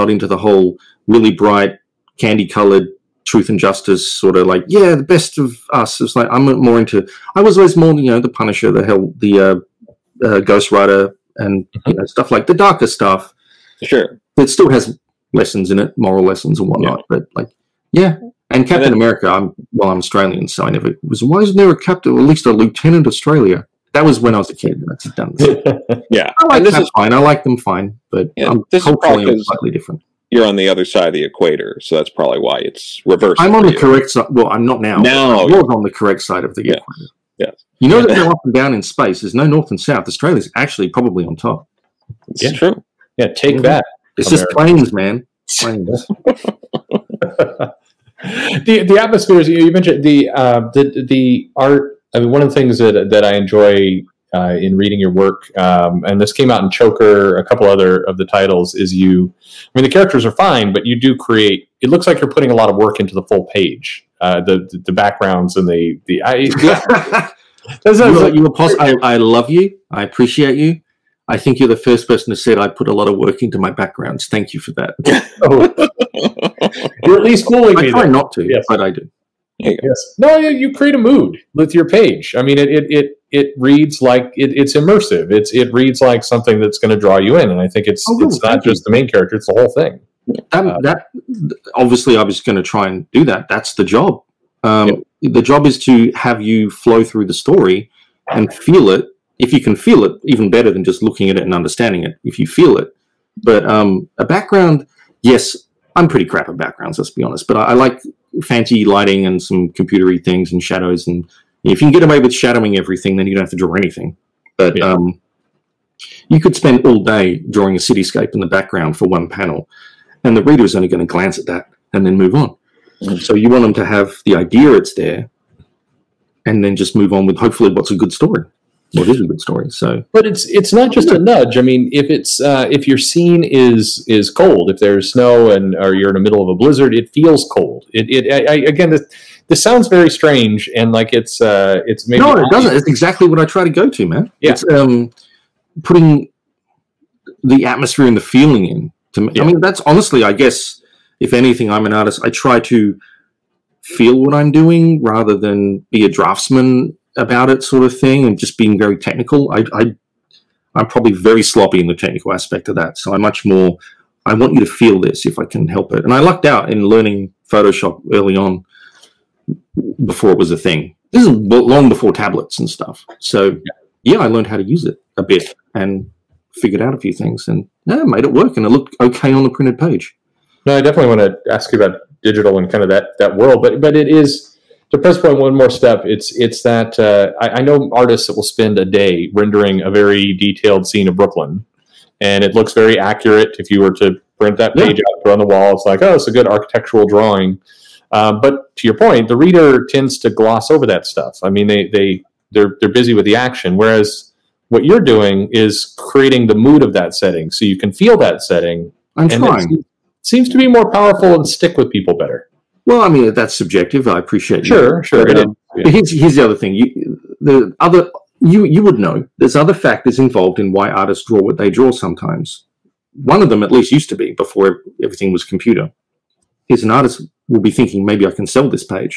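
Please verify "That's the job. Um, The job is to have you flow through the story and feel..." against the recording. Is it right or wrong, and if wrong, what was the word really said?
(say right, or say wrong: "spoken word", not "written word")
right.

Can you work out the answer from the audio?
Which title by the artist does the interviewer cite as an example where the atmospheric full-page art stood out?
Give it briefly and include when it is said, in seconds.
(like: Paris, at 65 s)
Choker, at 56 s.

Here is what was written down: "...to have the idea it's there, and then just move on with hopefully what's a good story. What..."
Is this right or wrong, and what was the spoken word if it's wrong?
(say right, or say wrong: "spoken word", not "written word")
right.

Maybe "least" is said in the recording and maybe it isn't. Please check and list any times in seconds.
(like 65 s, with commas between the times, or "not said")
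22 s, 77 s, 223 s.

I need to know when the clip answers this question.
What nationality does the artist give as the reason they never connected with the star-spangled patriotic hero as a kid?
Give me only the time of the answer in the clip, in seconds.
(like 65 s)
19 s.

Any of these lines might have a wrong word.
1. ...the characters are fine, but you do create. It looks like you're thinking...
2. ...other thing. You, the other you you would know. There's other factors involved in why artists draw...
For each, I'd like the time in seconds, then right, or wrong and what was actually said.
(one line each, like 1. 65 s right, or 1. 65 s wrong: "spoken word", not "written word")
1. 59 s wrong: "putting", not "thinking"
2. 216 s right.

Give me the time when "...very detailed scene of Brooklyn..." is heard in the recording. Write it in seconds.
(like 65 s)
189 s.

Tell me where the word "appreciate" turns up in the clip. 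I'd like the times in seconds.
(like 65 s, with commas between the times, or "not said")
70 s, 214 s.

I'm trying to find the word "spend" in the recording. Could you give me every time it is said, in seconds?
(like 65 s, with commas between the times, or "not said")
116 s, 188 s.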